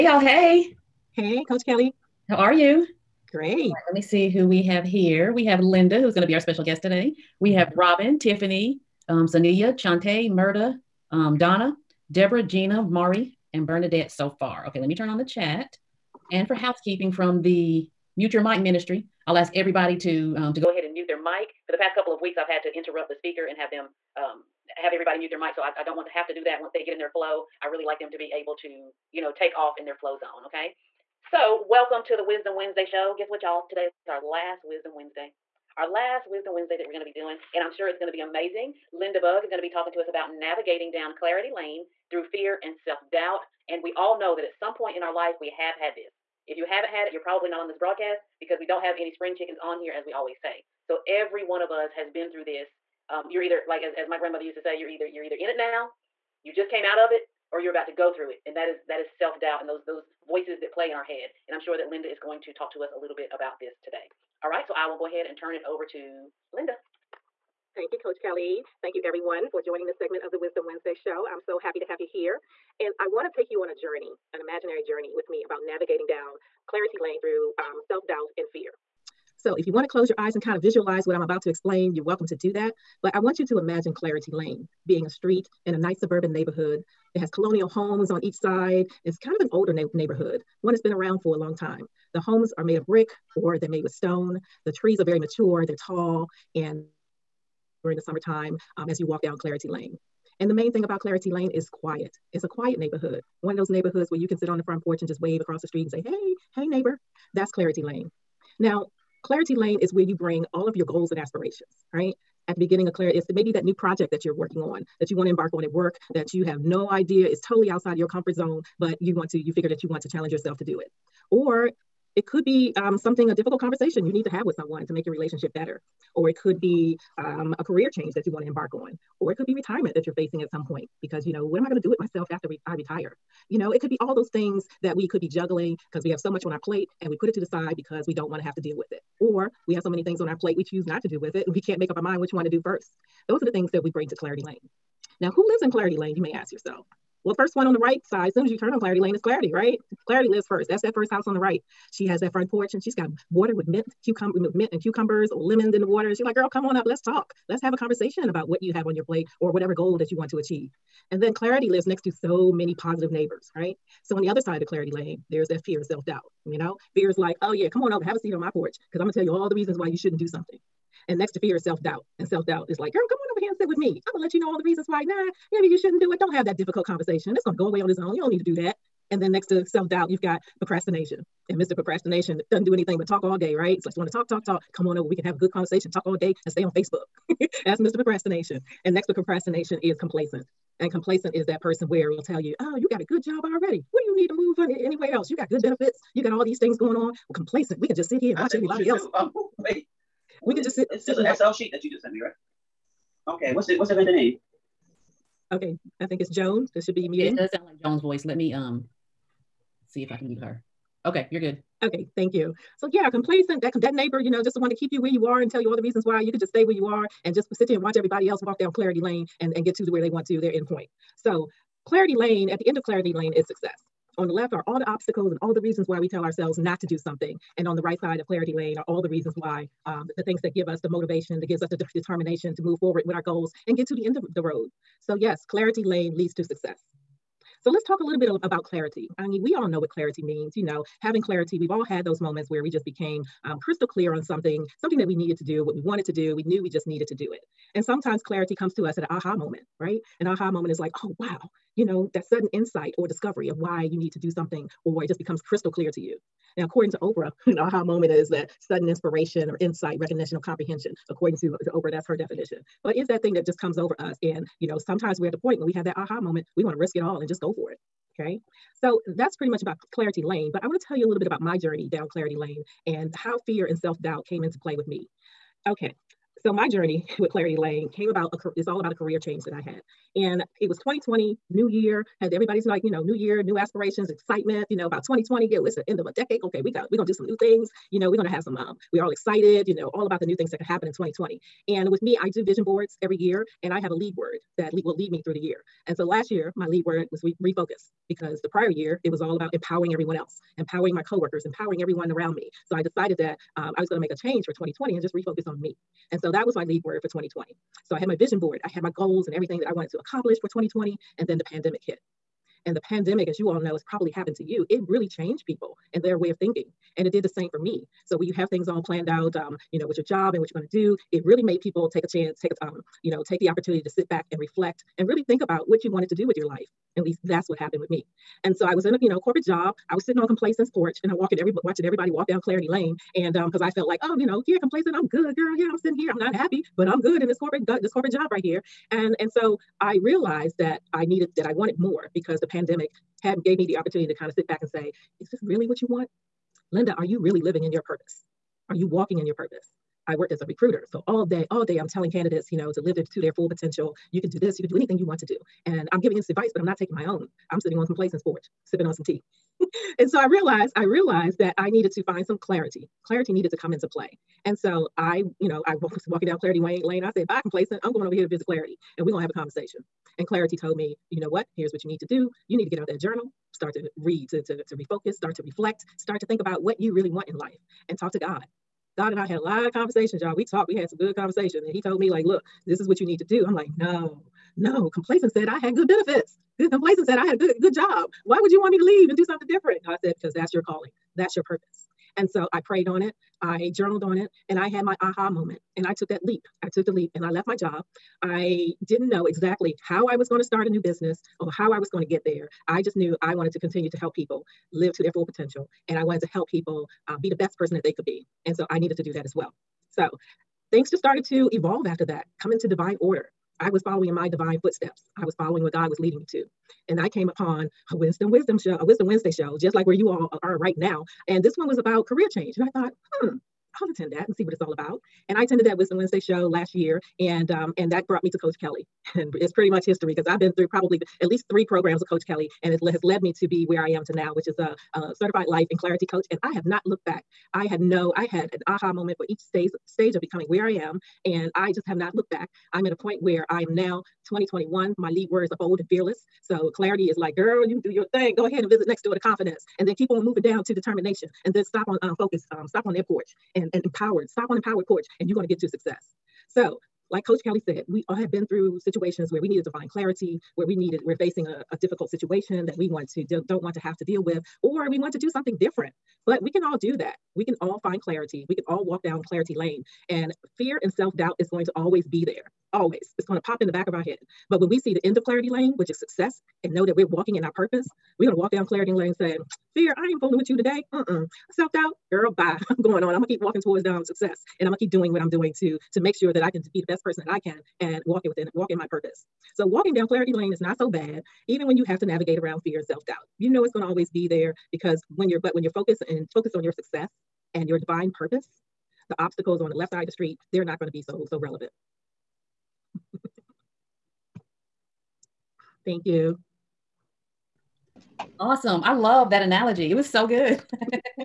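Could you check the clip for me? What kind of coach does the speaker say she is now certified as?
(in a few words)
Life and clarity coach.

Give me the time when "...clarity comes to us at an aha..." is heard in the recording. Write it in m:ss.
4:08.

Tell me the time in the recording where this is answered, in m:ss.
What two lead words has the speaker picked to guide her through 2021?
7:25.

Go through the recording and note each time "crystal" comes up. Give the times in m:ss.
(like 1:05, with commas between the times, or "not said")
4:03, 4:15.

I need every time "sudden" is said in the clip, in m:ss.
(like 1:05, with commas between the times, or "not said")
4:12, 4:18.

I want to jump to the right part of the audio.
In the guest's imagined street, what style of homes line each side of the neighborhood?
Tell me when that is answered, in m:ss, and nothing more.
1:27.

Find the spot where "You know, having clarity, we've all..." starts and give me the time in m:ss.
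4:00.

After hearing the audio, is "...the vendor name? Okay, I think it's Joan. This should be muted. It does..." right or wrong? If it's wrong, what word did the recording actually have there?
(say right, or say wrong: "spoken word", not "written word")
right.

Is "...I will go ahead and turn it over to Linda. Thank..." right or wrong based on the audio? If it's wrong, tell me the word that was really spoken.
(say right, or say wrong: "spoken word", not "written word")
right.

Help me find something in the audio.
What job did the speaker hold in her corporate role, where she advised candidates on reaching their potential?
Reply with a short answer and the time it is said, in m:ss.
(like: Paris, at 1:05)
Recruiter, at 5:50.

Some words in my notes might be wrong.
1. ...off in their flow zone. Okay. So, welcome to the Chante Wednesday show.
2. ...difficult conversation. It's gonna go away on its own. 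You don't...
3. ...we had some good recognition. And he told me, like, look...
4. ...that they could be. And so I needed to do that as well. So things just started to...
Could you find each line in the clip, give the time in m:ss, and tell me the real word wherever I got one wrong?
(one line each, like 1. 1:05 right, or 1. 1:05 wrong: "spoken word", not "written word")
1. 0:29 wrong: "Wisdom", not "Chante"
2. 2:56 right
3. 6:20 wrong: "conversation", not "recognition"
4. 6:47 right.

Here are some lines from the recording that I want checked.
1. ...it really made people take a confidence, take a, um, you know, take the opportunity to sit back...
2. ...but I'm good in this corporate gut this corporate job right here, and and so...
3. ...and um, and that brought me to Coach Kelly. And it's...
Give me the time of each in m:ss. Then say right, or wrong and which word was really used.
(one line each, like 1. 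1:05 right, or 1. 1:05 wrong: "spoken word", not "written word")
1. 5:21 wrong: "chance", not "confidence"
2. 5:36 right
3. 7:07 right.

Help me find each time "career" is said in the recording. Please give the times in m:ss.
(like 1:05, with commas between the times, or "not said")
2:07, 4:38, 7:02.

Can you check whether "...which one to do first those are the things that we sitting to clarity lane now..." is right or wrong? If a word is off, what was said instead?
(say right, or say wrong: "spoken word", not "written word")
wrong: "bring", not "sitting".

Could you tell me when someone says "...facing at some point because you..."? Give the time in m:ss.
2:10.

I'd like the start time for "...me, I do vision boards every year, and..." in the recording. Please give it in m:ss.
4:52.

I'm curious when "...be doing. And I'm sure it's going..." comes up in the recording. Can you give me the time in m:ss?
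0:37.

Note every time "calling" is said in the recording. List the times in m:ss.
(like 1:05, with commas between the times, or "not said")
6:30.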